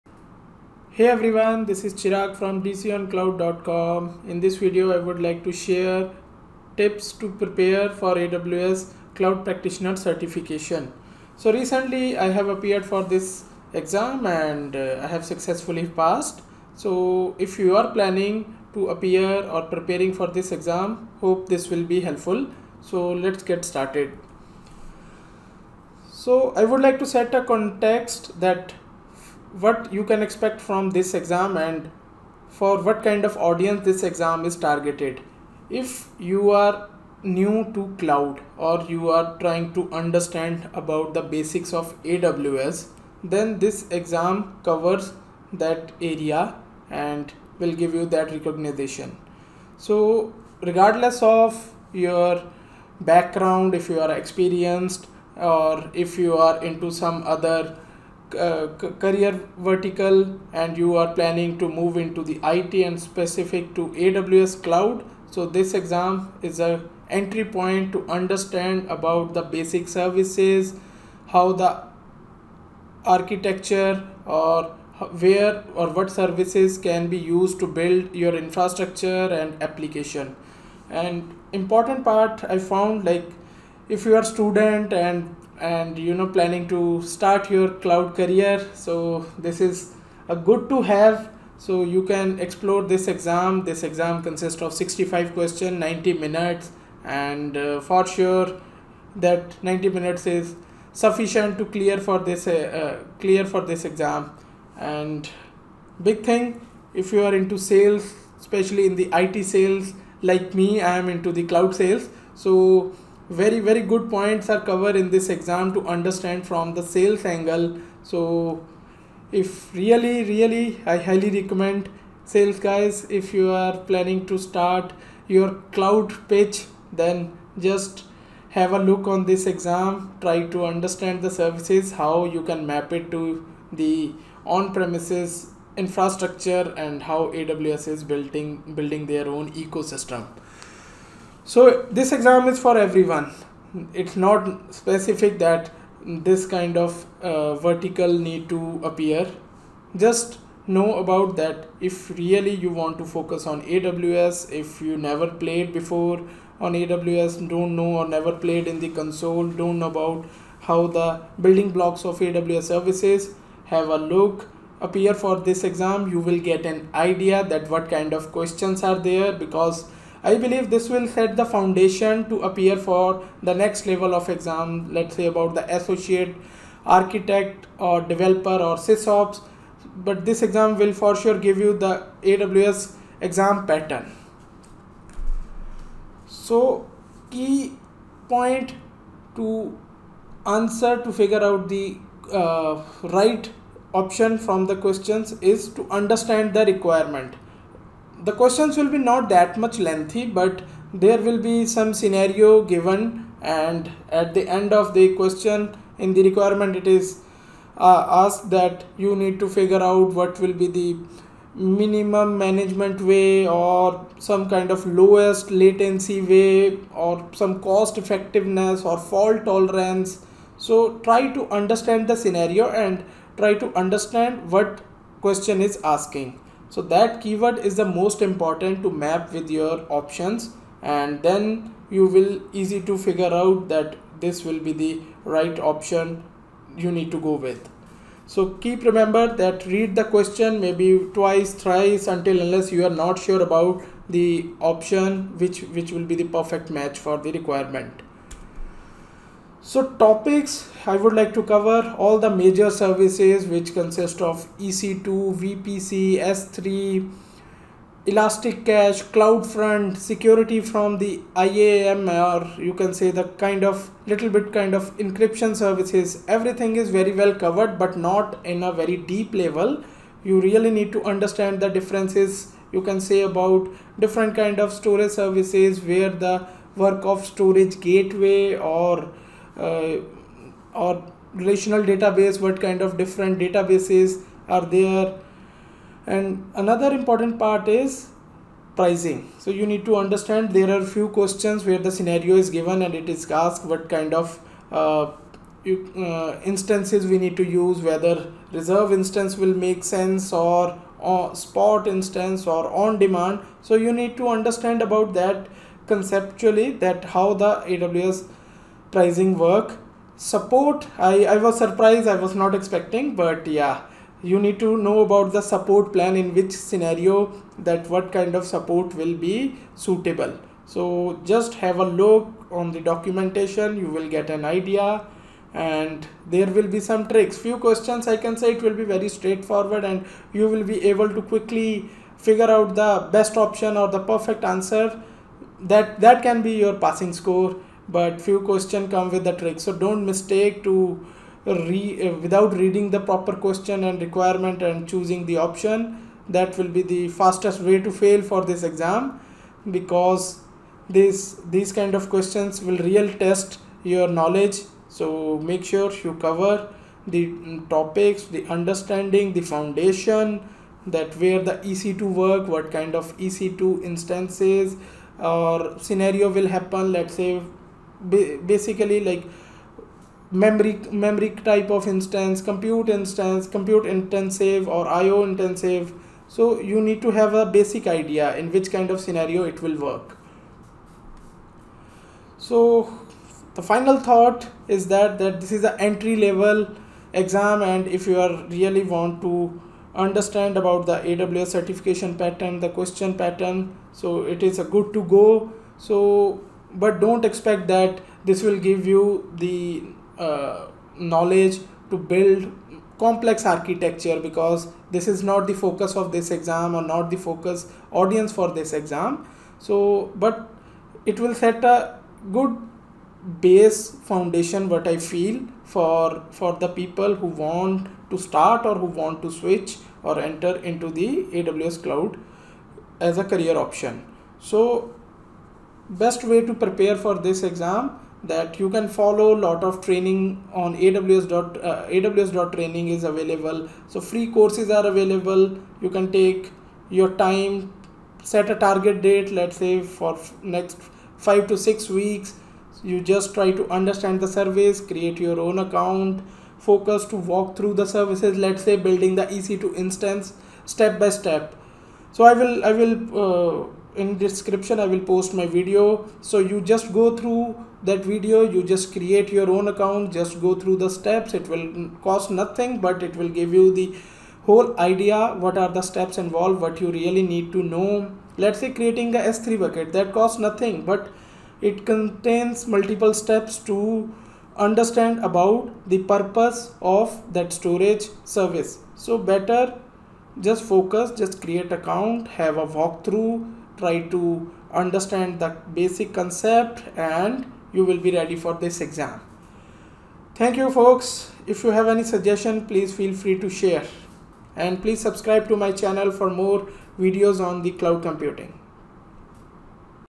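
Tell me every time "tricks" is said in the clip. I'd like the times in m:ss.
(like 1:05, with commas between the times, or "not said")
5:27, 5:39.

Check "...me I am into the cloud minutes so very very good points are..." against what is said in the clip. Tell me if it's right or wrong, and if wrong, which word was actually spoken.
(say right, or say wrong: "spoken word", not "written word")
wrong: "sales", not "minutes".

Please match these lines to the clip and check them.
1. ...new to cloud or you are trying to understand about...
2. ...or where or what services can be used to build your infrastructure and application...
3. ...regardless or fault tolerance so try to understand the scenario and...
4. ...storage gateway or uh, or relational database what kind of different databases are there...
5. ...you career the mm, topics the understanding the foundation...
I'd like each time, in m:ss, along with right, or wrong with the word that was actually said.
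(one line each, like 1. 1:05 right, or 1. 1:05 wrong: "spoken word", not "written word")
1. 0:37 right
2. 1:14 right
3. 3:37 wrong: "effectiveness", not "regardless"
4. 4:37 right
5. 5:56 wrong: "cover", not "career".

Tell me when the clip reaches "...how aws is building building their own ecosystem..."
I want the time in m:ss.
2:17.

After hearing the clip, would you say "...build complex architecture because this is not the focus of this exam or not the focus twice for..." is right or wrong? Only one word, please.
wrong.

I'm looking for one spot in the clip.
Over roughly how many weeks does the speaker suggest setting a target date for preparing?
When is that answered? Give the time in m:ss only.
7:21.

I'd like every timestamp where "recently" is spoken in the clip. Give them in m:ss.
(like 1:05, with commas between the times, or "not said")
0:11.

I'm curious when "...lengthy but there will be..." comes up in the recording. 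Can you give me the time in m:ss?
3:19.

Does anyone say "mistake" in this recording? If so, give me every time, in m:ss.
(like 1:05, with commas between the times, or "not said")
5:40.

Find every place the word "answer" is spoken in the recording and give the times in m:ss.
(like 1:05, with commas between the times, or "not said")
3:10, 5:34.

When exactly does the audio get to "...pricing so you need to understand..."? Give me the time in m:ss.
4:48.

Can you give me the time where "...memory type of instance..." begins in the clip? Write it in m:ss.
6:10.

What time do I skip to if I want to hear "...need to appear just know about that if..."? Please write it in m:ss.
2:28.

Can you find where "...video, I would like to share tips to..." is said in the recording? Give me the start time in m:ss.
0:04.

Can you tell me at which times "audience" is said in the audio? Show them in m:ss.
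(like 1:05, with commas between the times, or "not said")
0:33, 6:47.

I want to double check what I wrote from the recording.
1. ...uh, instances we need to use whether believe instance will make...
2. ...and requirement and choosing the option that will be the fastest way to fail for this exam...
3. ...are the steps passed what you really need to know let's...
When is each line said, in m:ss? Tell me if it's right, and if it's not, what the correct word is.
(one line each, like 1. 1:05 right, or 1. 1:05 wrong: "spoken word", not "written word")
1. 4:56 wrong: "reserve", not "believe"
2. 5:43 right
3. 7:45 wrong: "involved", not "passed".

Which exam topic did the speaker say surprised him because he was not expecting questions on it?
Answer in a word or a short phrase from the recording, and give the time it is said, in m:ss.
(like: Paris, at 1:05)
support plan, at 5:15.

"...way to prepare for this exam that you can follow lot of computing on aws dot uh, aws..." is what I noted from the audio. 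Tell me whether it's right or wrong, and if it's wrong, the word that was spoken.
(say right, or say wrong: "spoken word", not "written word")
wrong: "training", not "computing".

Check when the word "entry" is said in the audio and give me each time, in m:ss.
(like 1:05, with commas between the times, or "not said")
1:07, 6:25.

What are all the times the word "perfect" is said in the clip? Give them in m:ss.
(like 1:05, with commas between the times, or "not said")
4:06, 5:34.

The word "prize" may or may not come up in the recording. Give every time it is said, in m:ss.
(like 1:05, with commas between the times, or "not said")
not said.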